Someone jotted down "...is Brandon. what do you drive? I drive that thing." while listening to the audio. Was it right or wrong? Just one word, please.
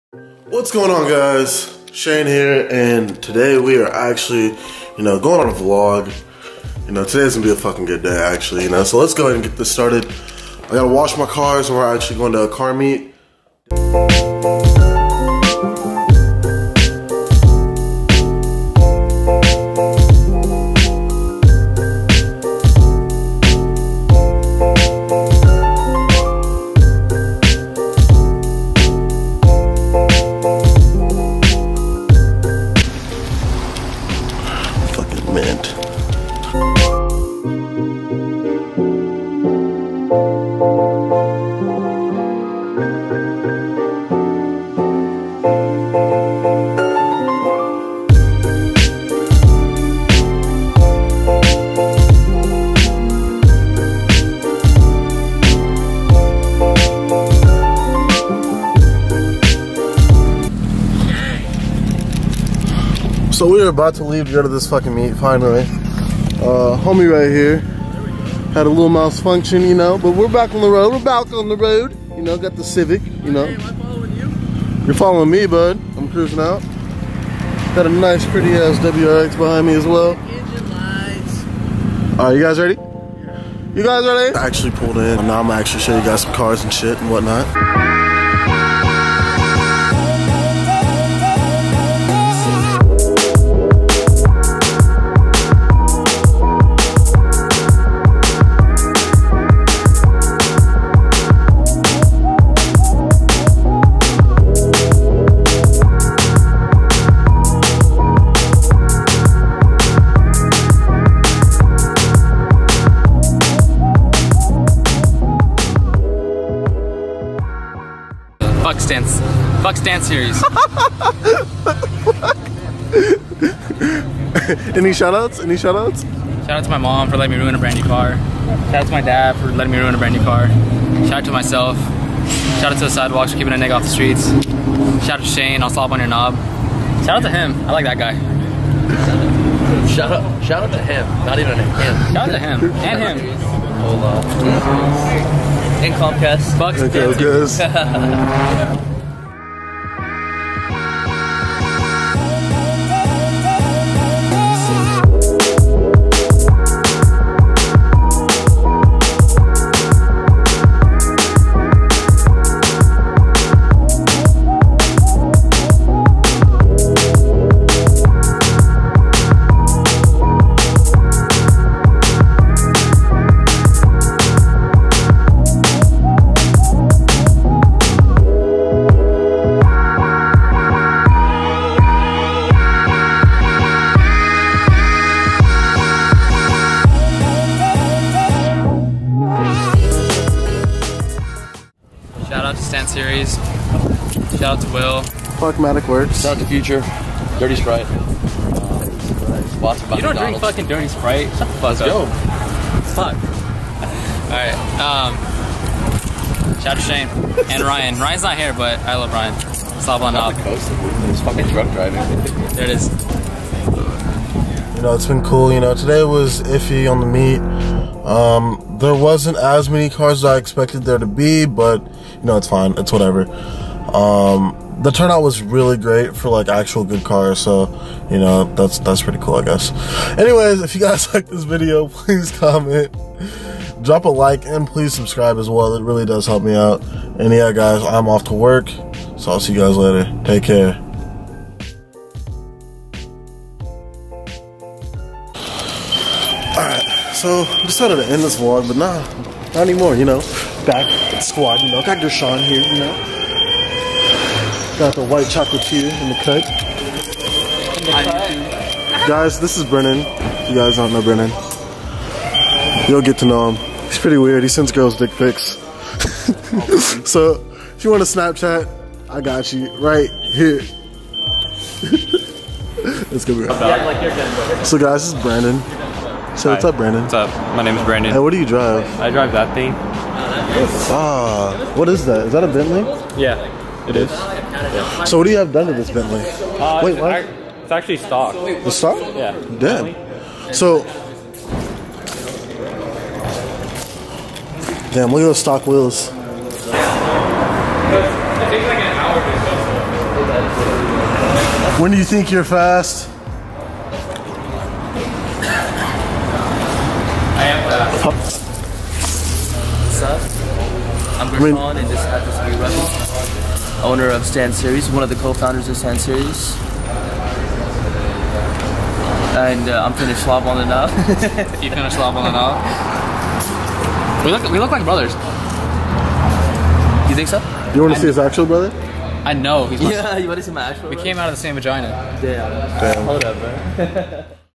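right.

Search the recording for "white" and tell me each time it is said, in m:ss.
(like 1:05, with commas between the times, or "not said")
4:15.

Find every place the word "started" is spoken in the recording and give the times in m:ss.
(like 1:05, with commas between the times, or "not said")
0:09.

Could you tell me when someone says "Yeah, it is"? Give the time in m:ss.
4:43.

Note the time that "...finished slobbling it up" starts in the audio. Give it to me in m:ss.
5:21.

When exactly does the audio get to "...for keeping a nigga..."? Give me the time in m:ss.
2:13.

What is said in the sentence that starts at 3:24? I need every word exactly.
Um, shout out to Shane and Ryan.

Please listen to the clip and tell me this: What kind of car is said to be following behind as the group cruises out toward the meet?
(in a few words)
WRX.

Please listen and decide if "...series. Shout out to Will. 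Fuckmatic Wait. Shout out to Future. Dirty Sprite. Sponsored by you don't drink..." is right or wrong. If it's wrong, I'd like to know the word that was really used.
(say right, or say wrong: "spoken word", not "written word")
wrong: "Works", not "Wait".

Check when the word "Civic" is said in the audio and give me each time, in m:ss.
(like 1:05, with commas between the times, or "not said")
1:12.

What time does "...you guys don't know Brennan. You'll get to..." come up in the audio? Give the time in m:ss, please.
4:20.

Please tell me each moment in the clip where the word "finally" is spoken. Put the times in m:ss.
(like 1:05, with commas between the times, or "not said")
1:05.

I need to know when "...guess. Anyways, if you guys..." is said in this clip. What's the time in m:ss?
3:49.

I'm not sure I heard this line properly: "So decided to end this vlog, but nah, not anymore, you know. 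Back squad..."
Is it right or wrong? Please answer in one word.
right.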